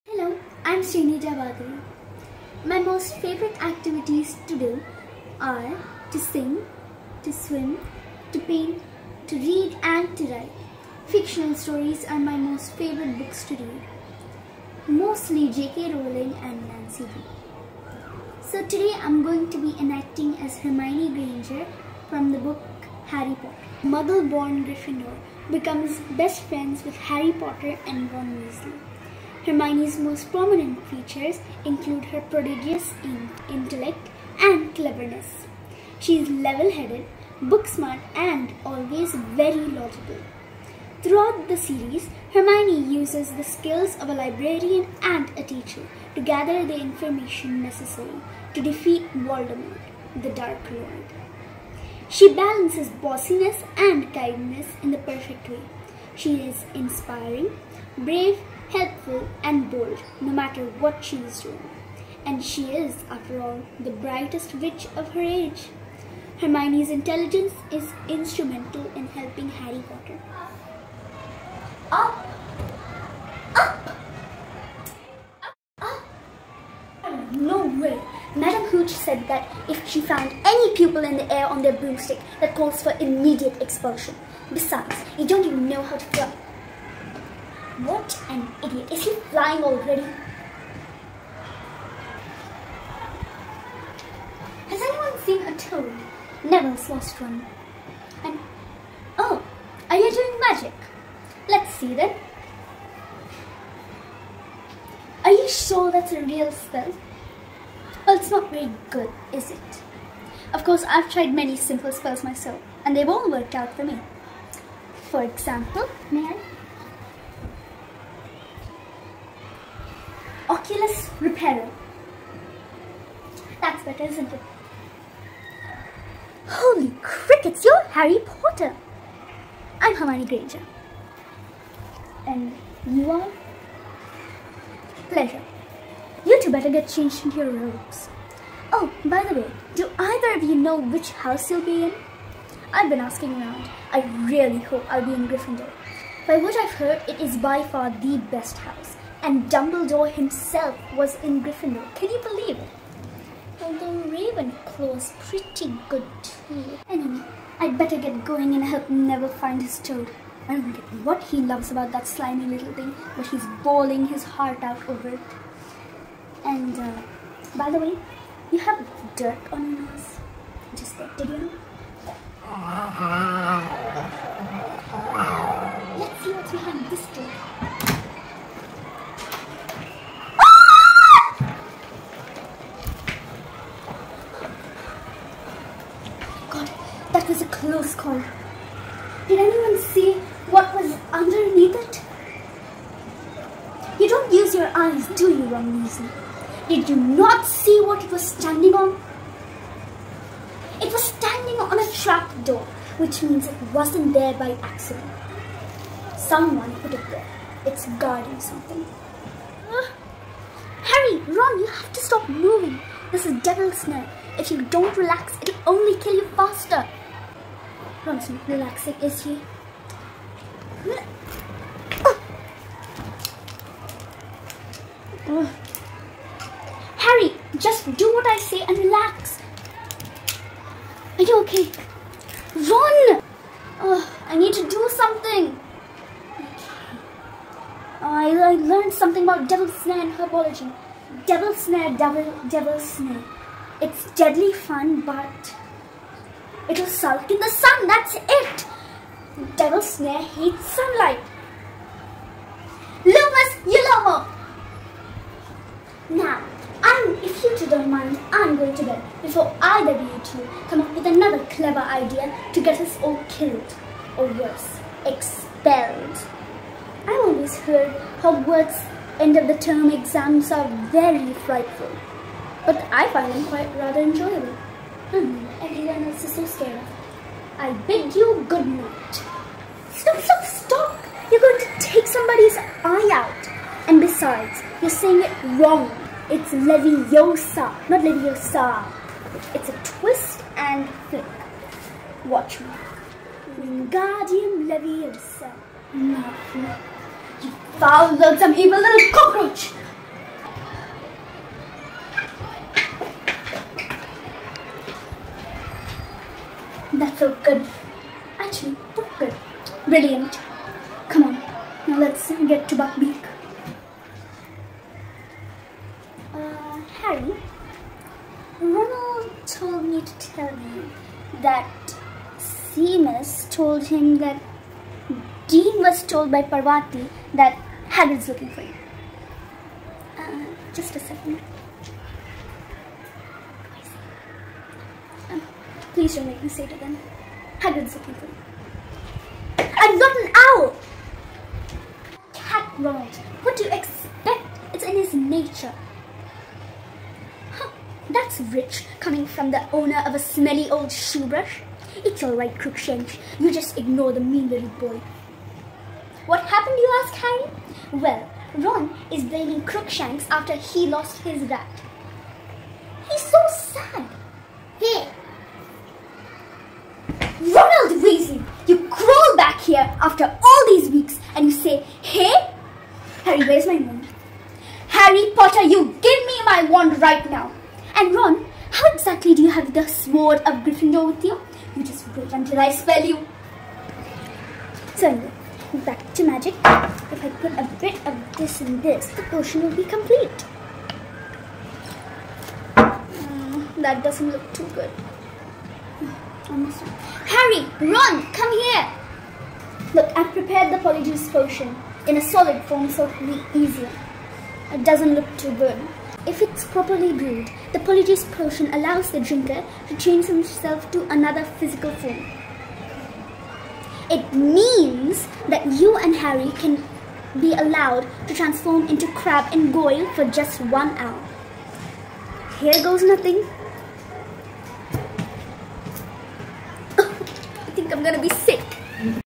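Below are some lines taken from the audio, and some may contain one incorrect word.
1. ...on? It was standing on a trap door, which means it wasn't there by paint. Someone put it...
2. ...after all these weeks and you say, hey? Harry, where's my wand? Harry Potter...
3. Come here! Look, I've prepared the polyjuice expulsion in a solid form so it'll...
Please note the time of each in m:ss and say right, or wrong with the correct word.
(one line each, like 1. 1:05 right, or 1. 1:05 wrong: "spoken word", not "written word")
1. 3:18 wrong: "accident", not "paint"
2. 6:10 right
3. 6:38 wrong: "potion", not "expulsion".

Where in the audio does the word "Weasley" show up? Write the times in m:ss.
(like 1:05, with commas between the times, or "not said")
0:28, 6:08.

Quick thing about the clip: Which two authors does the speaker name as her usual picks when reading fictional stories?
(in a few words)
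J.K. Rowling and Nancy Drew.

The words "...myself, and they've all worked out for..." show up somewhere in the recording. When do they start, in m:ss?
1:52.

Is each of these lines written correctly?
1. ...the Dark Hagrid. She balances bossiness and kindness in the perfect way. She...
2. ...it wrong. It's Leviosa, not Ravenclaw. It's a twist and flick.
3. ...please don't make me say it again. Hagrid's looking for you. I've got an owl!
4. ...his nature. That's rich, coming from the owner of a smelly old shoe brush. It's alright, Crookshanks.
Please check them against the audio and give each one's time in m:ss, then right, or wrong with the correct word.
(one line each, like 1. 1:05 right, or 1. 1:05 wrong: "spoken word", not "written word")
1. 0:50 wrong: "Lord", not "Hagrid"
2. 4:45 wrong: "Leviosa", not "Ravenclaw"
3. 5:35 right
4. 5:44 right.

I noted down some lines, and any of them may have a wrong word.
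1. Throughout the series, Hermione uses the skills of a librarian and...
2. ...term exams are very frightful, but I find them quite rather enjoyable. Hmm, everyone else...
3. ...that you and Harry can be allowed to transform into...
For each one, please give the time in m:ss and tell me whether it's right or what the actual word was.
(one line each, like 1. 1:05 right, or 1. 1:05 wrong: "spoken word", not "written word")
1. 0:41 right
2. 4:29 right
3. 6:55 right.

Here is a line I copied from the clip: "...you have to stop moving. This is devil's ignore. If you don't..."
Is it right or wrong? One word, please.
wrong.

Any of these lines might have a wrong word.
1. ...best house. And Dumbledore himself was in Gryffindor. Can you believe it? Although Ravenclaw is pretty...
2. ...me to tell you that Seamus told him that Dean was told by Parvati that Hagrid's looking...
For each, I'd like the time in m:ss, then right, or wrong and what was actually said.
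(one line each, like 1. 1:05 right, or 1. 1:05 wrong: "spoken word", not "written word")
1. 2:28 right
2. 5:19 right.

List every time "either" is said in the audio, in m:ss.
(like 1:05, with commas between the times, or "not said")
2:19, 4:19.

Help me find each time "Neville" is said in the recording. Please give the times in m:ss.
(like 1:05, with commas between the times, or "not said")
1:36, 2:38.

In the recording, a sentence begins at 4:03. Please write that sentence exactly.
It's deadly fun, but it'll sulk in the sun.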